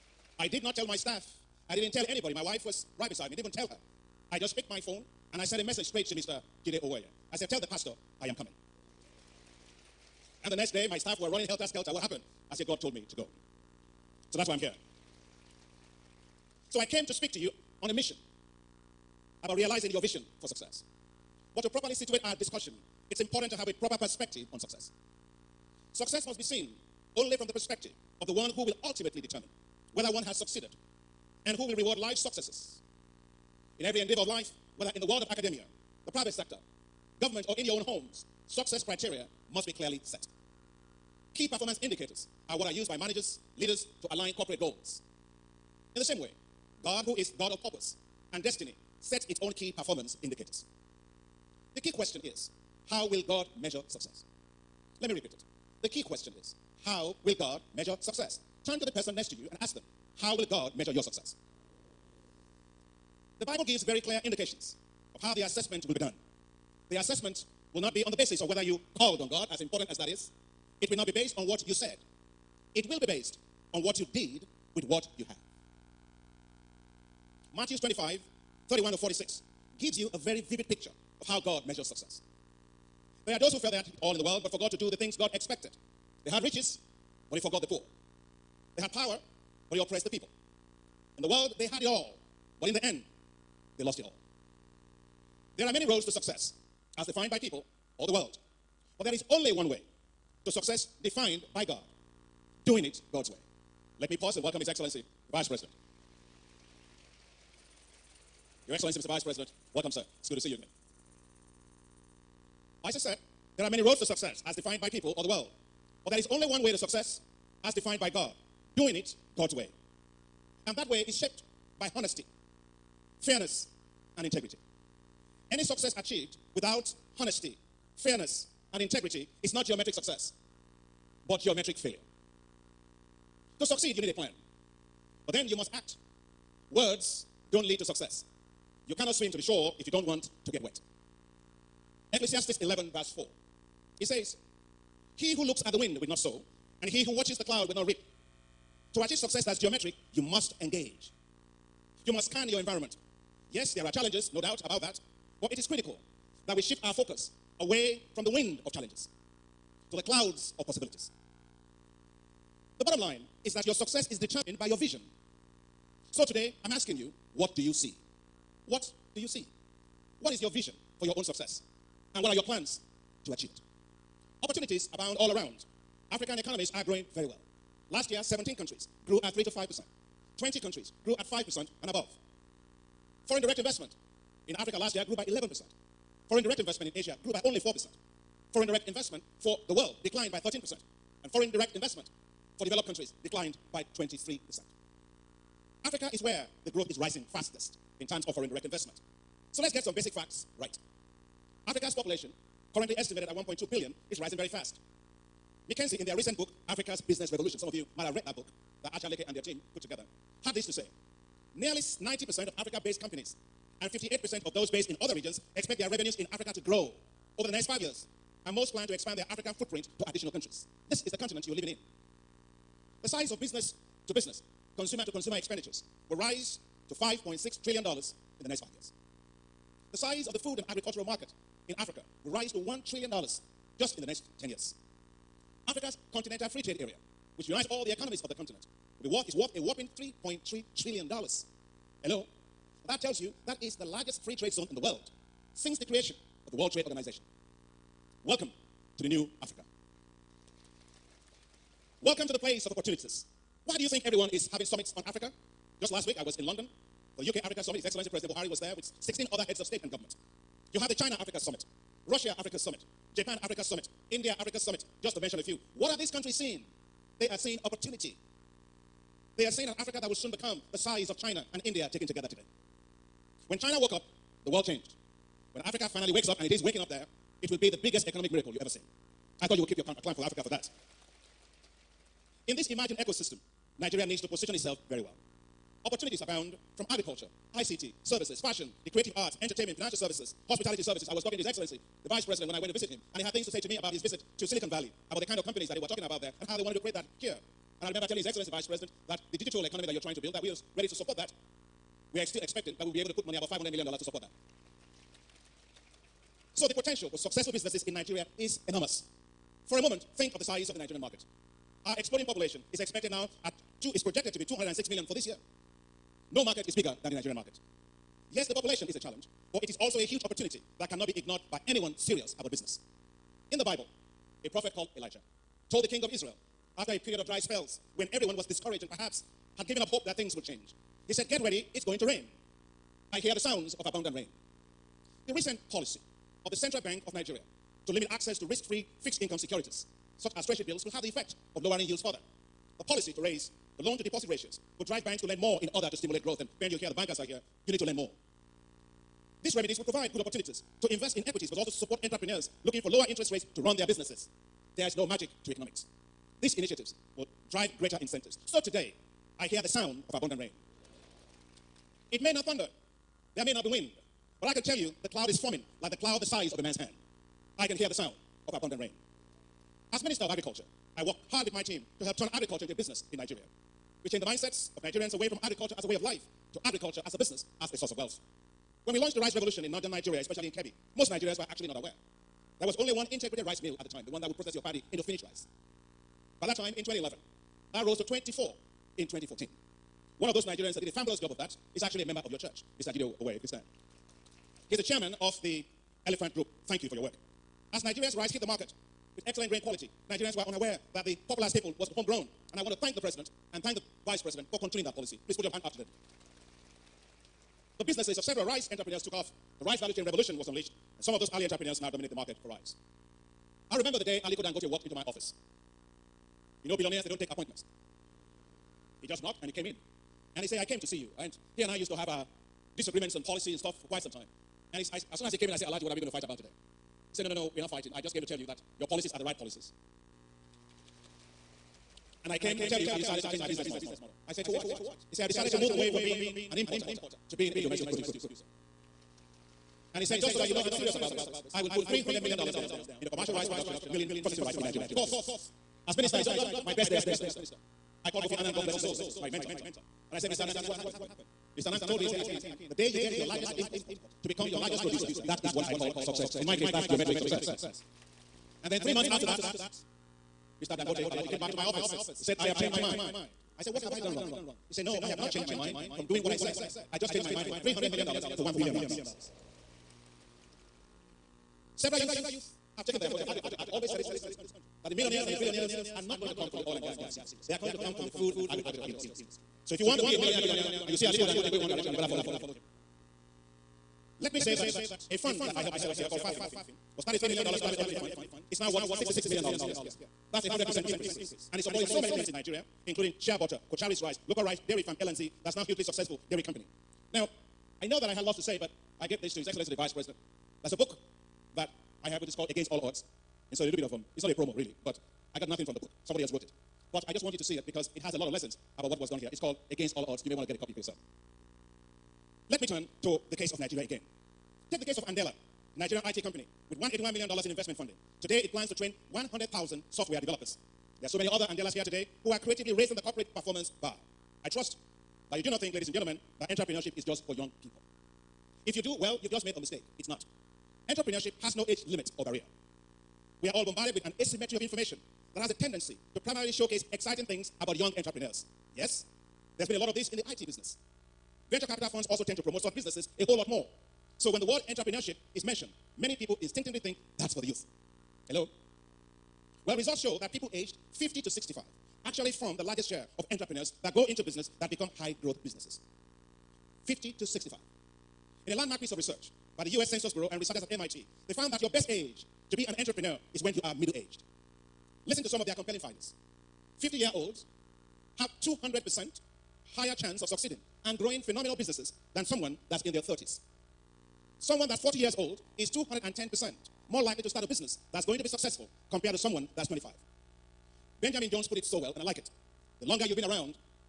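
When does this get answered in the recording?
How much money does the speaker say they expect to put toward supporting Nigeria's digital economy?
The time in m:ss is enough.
5:03.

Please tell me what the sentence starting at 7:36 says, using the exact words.
In my case, that's geometric success.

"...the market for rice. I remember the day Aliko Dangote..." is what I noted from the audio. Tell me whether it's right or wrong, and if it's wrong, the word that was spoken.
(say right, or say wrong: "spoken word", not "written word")
right.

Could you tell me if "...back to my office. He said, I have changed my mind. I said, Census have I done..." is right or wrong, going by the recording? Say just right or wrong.
wrong.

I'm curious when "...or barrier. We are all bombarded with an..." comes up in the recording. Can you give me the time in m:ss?
8:52.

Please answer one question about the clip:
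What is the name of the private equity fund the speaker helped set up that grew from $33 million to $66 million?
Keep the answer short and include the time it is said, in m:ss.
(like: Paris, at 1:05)
FAFIN, at 8:06.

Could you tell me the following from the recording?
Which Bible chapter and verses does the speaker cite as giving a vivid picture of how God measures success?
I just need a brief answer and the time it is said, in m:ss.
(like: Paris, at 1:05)
Matthew 25:31-46, at 1:17.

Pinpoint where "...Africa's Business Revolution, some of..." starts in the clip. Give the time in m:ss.
3:26.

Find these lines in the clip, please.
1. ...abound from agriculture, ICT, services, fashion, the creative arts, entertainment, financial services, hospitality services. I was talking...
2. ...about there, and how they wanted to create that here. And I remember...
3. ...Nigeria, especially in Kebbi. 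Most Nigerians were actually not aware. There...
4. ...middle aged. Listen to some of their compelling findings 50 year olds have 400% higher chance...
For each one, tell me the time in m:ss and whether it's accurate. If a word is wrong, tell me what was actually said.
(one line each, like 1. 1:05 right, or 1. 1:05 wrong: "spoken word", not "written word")
1. 4:46 right
2. 4:56 right
3. 6:19 right
4. 9:23 wrong: "200", not "400".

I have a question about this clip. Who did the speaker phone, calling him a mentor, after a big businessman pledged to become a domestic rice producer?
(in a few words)
Kofi Annan.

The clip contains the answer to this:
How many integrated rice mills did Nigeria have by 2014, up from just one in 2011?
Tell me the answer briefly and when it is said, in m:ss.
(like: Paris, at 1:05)
24, at 6:28.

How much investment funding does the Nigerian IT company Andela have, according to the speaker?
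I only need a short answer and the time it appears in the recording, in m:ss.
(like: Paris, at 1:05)
$181 million, at 8:36.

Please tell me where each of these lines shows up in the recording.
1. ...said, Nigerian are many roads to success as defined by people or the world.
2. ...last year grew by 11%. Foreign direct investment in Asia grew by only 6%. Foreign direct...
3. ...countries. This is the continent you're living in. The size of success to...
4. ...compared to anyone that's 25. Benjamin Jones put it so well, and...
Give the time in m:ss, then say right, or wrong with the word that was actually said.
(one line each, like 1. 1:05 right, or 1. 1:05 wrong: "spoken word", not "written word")
1. 1:53 wrong: "There", not "Nigerian"
2. 3:04 wrong: "4", not "6"
3. 3:40 wrong: "business", not "success"
4. 9:38 wrong: "someone", not "anyone".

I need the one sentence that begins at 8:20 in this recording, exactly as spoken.
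That's a book that I have, which is called Against All Odds.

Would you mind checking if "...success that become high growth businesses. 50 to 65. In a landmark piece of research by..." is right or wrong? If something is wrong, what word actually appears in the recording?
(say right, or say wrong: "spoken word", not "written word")
wrong: "business", not "success".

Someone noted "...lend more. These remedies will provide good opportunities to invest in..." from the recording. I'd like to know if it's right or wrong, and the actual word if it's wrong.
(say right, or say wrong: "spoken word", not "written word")
right.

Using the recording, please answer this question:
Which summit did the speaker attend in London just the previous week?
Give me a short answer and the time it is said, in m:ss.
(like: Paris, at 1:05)
UK Africa Summit, at 4:17.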